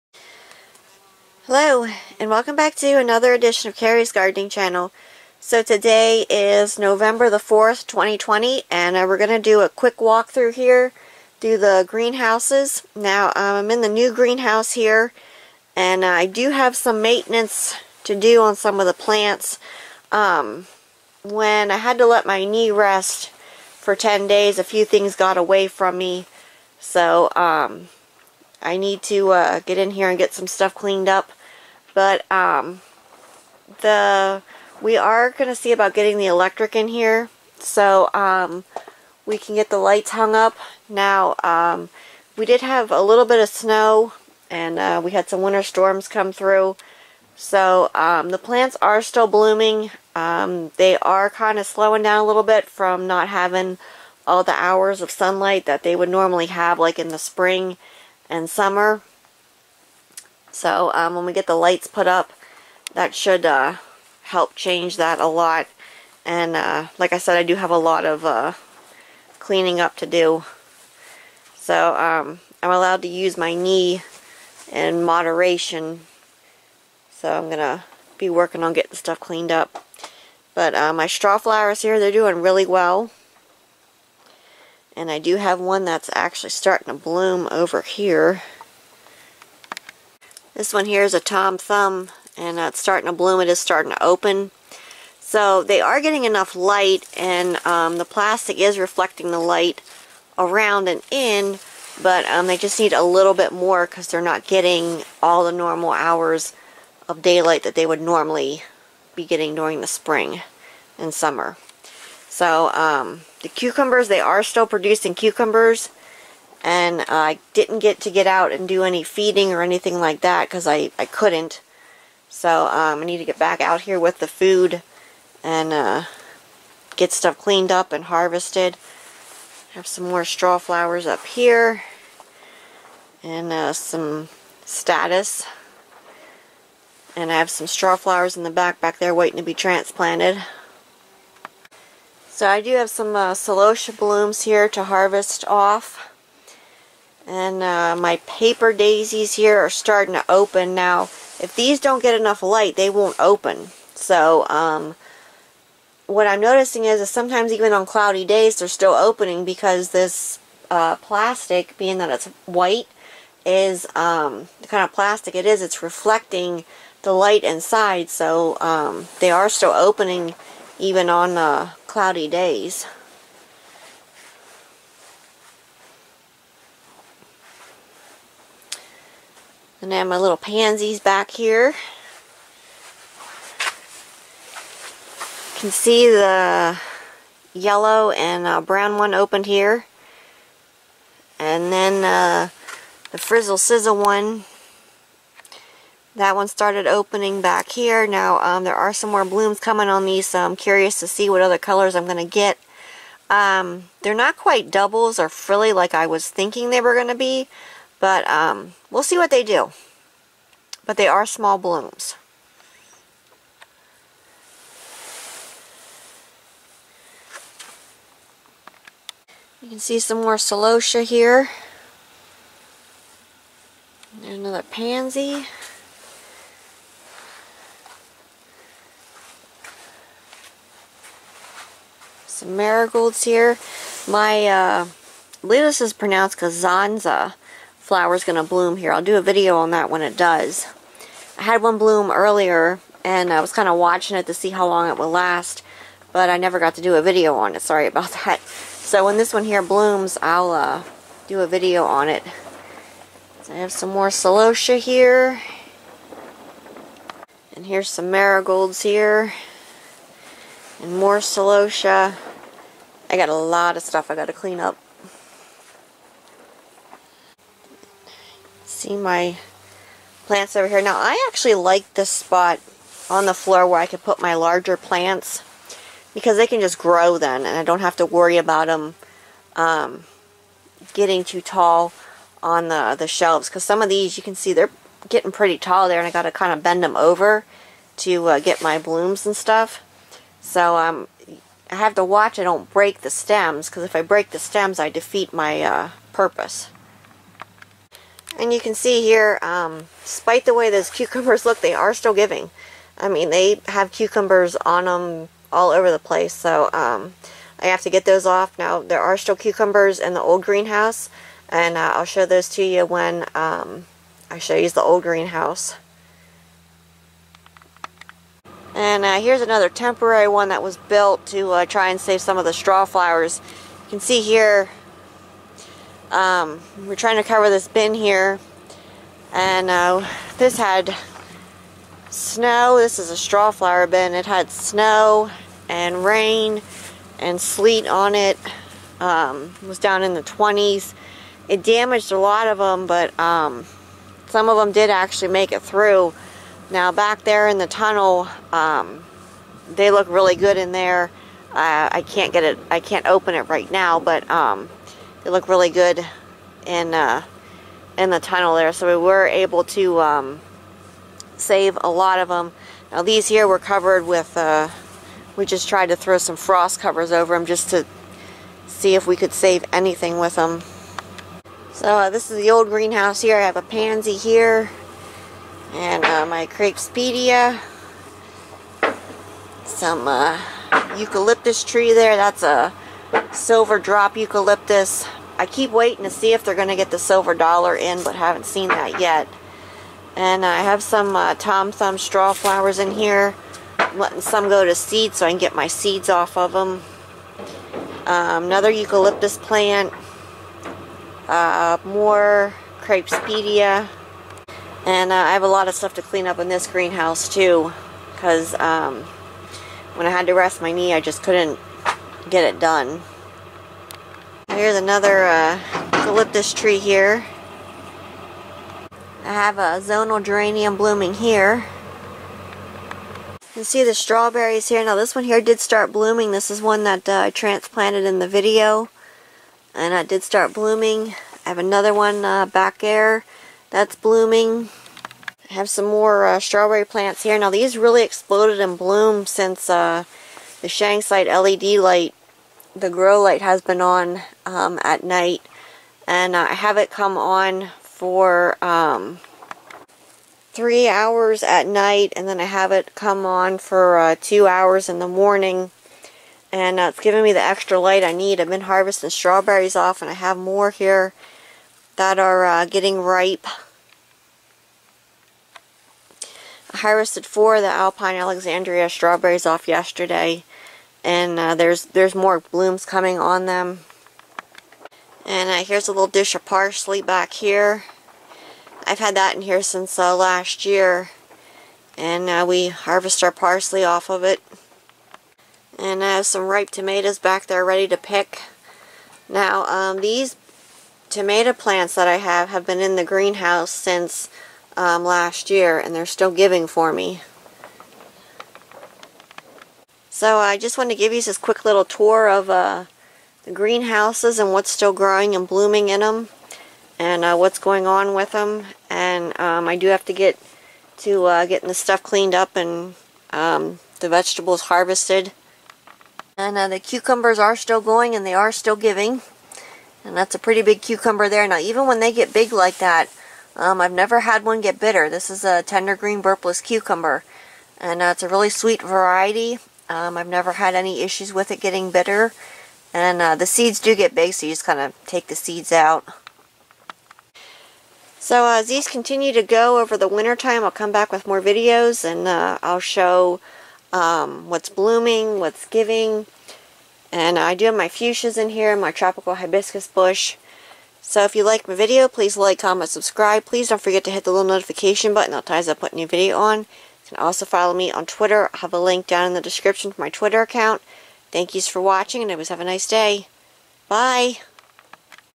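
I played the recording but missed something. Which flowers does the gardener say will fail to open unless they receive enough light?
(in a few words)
paper daisies.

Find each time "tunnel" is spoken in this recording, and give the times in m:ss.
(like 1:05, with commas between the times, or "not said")
5:47, 5:58.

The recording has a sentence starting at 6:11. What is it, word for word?
So uh, this is the old greenhouse here.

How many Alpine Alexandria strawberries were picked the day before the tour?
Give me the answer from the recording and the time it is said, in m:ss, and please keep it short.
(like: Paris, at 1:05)
4, at 7:47.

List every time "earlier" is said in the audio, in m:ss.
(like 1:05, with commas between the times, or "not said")
4:02.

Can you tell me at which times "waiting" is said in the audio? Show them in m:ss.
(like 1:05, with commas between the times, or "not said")
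2:19, 6:25.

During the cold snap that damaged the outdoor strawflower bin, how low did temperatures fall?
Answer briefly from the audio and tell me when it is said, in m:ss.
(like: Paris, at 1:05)
the 20s, at 5:40.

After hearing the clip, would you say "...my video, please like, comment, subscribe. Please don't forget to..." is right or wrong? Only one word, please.
right.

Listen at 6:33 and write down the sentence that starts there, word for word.
I'm letting some go to seed so I can get my seeds off of them.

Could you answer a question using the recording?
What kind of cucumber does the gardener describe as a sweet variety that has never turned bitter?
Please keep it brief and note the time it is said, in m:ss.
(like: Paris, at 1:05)
tender green burpless, at 8:45.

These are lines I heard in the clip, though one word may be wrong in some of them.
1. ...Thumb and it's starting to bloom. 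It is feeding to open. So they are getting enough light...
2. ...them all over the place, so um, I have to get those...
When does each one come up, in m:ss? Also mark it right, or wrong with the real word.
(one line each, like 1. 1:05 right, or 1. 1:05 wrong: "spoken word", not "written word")
1. 1:31 wrong: "starting", not "feeding"
2. 5:04 right.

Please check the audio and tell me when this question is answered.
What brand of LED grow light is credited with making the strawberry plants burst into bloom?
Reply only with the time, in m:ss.
7:20.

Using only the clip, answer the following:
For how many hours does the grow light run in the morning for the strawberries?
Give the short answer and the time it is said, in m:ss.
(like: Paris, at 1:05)
2, at 7:34.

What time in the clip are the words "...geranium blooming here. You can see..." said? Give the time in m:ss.
7:00.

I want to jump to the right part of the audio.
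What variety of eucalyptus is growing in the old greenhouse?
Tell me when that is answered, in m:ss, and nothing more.
6:23.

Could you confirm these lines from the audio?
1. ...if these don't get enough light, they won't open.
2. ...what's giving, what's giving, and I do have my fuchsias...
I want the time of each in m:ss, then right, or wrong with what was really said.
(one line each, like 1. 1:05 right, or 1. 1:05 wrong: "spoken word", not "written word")
1. 2:31 right
2. 9:04 wrong: "blooming", not "giving".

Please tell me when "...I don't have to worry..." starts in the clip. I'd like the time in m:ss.
4:37.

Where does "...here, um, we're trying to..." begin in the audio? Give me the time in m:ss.
5:24.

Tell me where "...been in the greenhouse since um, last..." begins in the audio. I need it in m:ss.
8:12.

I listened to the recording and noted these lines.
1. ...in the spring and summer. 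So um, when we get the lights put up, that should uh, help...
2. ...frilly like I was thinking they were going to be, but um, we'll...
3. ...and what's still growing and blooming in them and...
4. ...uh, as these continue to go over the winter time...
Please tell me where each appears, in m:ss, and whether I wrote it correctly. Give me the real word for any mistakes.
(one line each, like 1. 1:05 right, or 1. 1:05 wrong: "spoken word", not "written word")
1. 0:56 right
2. 3:25 right
3. 8:24 right
4. 8:58 right.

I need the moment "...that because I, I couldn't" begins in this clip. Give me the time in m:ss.
2:00.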